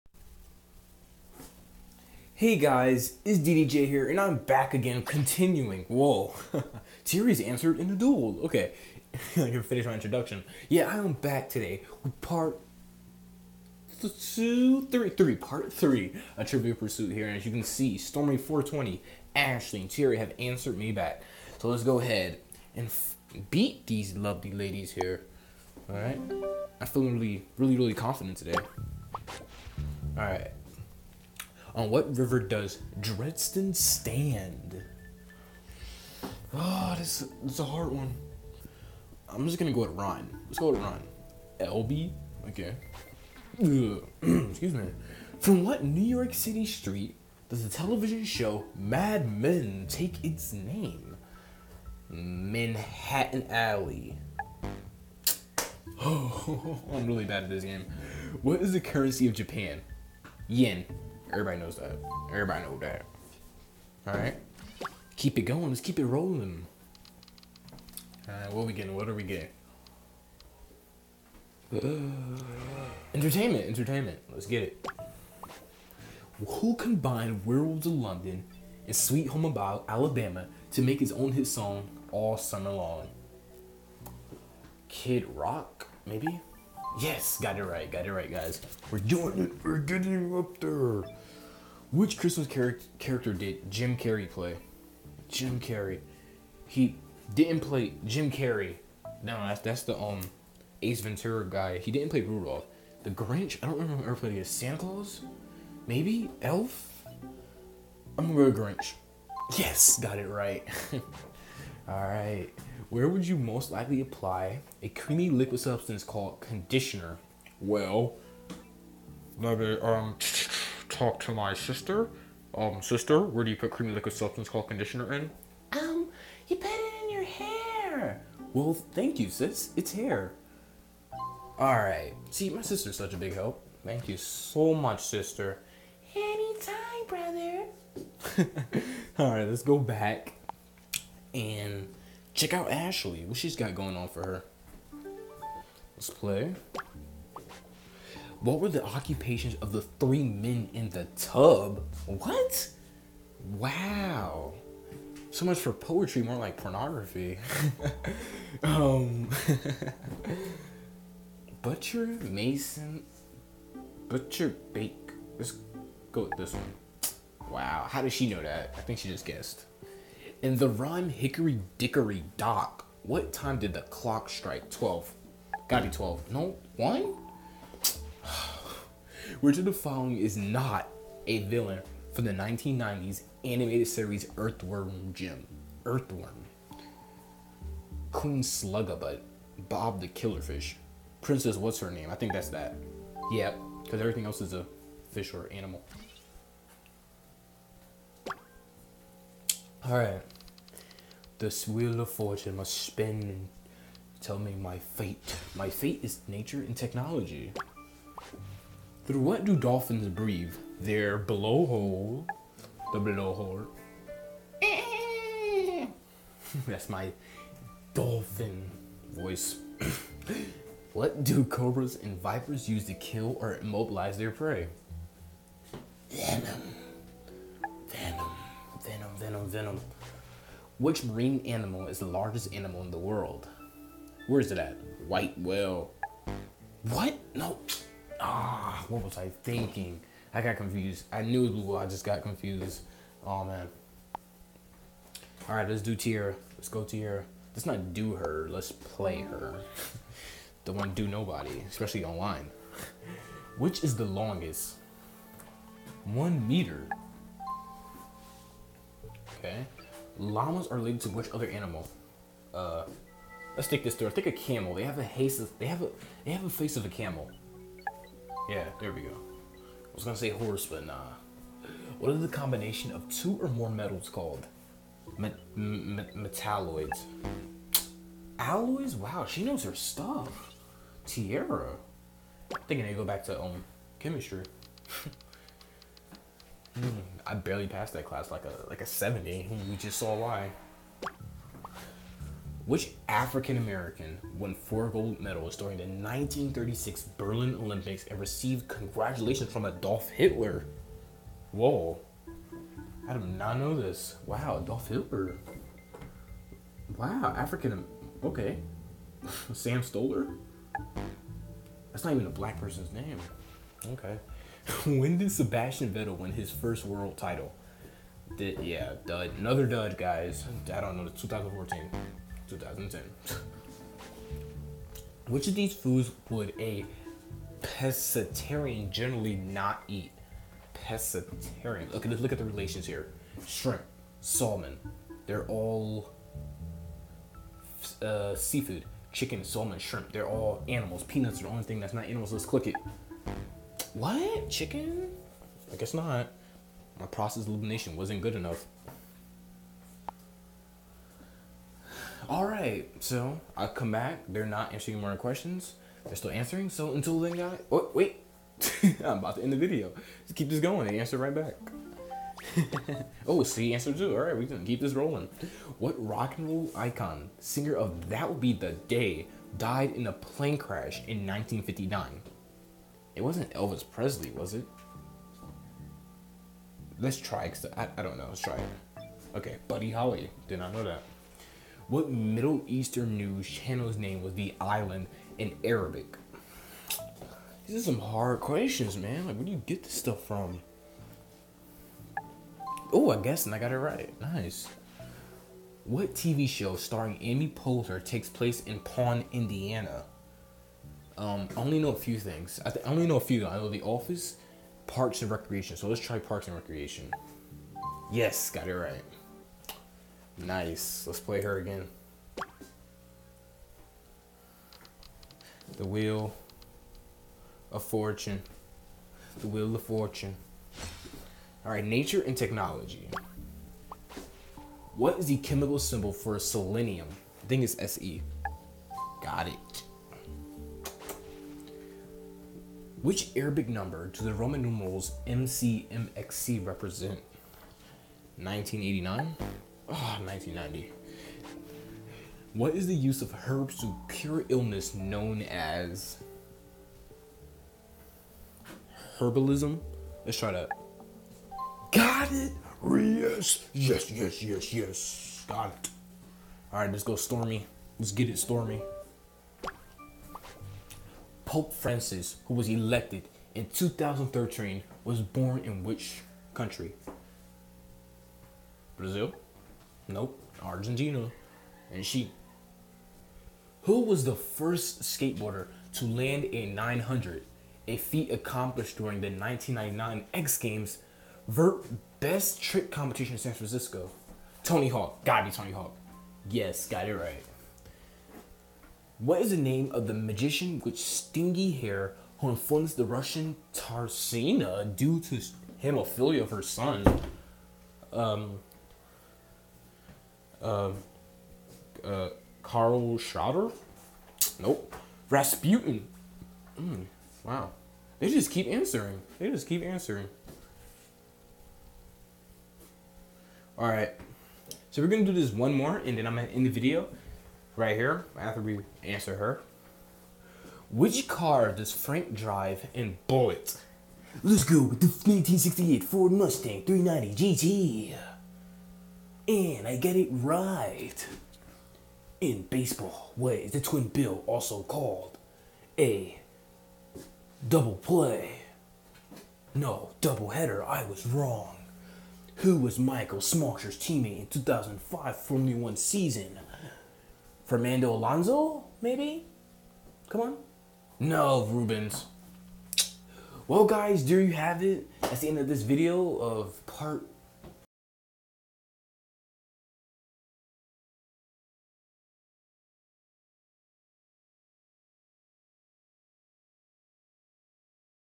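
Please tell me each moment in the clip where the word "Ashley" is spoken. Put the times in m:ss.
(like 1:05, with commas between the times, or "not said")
0:19, 2:22.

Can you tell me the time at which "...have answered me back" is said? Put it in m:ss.
0:20.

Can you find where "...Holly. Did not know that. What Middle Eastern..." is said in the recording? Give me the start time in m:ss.
6:19.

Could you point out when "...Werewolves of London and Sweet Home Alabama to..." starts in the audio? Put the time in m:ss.
1:17.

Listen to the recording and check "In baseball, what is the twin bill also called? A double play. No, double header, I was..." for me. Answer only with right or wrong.
right.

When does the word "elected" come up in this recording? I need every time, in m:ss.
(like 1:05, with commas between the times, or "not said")
7:42.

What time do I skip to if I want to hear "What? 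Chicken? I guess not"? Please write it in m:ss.
5:43.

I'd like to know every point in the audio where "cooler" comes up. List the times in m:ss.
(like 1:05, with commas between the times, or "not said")
not said.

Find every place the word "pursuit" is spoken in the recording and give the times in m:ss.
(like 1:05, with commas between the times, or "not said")
0:16.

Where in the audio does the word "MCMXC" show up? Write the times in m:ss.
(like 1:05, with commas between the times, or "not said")
7:15.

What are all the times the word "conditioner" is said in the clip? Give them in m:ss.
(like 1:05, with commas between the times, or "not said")
1:56, 2:04.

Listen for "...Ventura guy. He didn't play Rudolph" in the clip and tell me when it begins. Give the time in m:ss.
1:41.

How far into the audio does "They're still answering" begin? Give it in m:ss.
5:56.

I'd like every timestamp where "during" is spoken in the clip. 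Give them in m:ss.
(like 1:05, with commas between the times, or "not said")
4:55, 7:58.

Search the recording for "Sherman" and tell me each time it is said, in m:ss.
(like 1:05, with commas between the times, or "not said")
not said.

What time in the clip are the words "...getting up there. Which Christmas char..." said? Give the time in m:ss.
1:29.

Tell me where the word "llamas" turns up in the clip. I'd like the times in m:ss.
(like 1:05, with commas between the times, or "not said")
4:20.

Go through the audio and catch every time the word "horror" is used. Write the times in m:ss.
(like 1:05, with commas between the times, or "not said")
not said.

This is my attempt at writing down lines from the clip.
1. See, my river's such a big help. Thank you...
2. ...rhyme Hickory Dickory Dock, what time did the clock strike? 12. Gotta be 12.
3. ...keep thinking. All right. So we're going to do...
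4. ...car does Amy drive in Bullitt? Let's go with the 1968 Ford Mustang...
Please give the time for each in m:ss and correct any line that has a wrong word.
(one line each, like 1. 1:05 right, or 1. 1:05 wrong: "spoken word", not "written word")
1. 2:12 wrong: "sister", not "river"
2. 2:50 right
3. 8:29 wrong: "answering", not "thinking"
4. 8:41 wrong: "Frank", not "Amy".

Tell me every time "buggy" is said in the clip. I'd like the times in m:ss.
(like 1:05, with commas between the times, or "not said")
not said.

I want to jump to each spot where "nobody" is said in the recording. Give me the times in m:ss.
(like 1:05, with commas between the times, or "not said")
4:11.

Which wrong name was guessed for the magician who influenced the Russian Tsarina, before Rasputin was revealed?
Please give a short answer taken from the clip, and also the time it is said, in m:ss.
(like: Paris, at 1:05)
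Karl Schroeder, at 8:22.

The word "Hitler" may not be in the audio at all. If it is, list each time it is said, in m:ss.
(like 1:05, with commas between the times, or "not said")
5:00, 5:04.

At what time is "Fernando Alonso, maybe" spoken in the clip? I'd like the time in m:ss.
9:07.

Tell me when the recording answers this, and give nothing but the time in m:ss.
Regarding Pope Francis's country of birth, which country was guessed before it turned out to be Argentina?
7:48.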